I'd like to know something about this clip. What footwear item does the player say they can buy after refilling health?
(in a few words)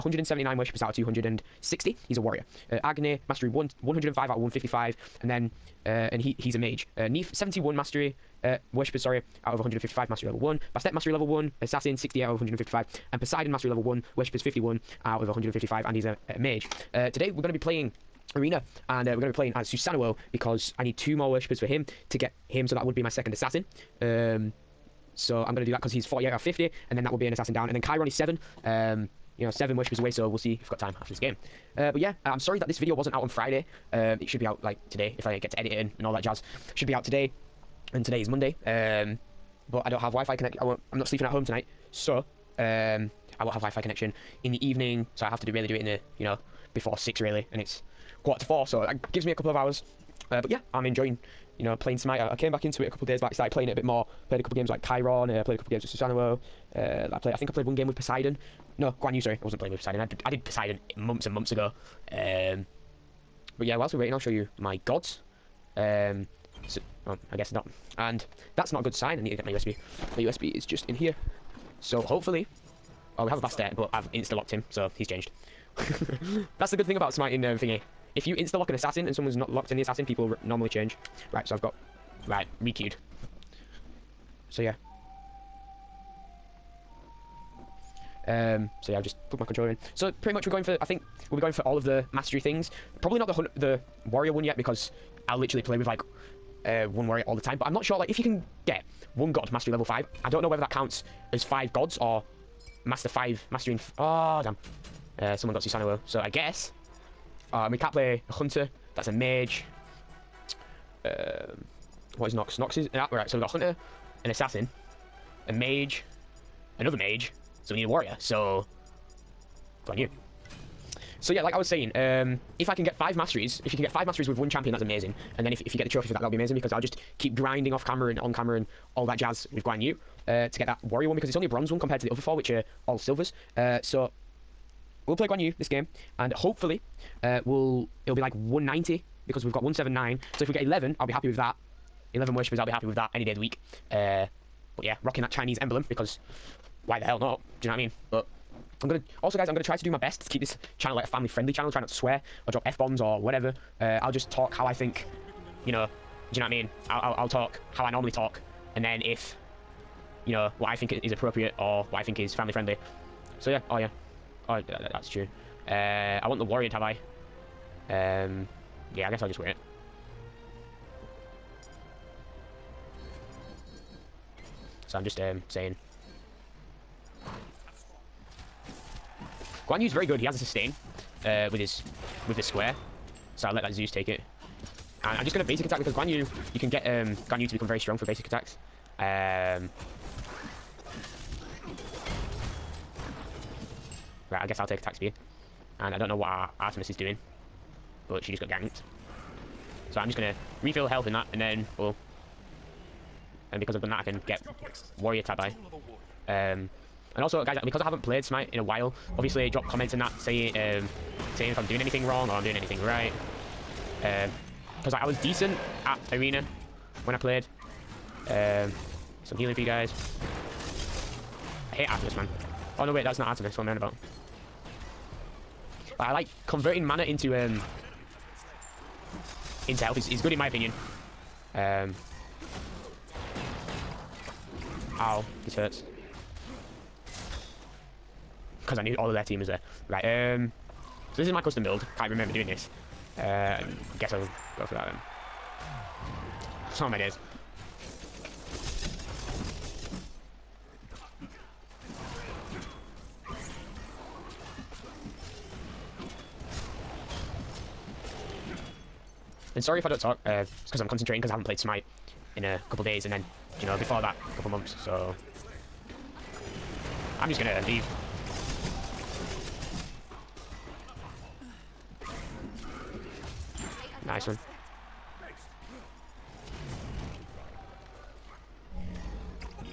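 Warrior Tabi.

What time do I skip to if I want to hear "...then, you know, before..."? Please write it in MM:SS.
04:23.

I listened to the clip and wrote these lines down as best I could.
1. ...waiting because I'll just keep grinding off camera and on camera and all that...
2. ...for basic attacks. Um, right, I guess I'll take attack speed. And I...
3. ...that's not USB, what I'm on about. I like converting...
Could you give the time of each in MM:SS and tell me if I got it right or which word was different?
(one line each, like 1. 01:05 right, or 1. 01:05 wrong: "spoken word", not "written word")
1. 02:06 wrong: "amazing", not "waiting"
2. 03:07 right
3. 03:43 wrong: "Artemis", not "USB".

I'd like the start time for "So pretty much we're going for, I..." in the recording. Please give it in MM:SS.
01:29.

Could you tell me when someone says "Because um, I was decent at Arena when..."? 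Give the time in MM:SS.
03:34.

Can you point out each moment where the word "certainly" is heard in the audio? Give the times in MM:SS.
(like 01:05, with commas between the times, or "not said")
not said.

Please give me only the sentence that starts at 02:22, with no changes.
11 worshippers, I'll be happy with that any day of the week.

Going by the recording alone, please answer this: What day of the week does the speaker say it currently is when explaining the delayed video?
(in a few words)
Monday.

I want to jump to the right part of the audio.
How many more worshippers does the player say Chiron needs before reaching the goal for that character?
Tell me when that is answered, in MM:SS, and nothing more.
00:29.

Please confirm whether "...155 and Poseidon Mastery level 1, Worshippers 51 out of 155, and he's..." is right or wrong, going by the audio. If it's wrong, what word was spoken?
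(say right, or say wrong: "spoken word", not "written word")
right.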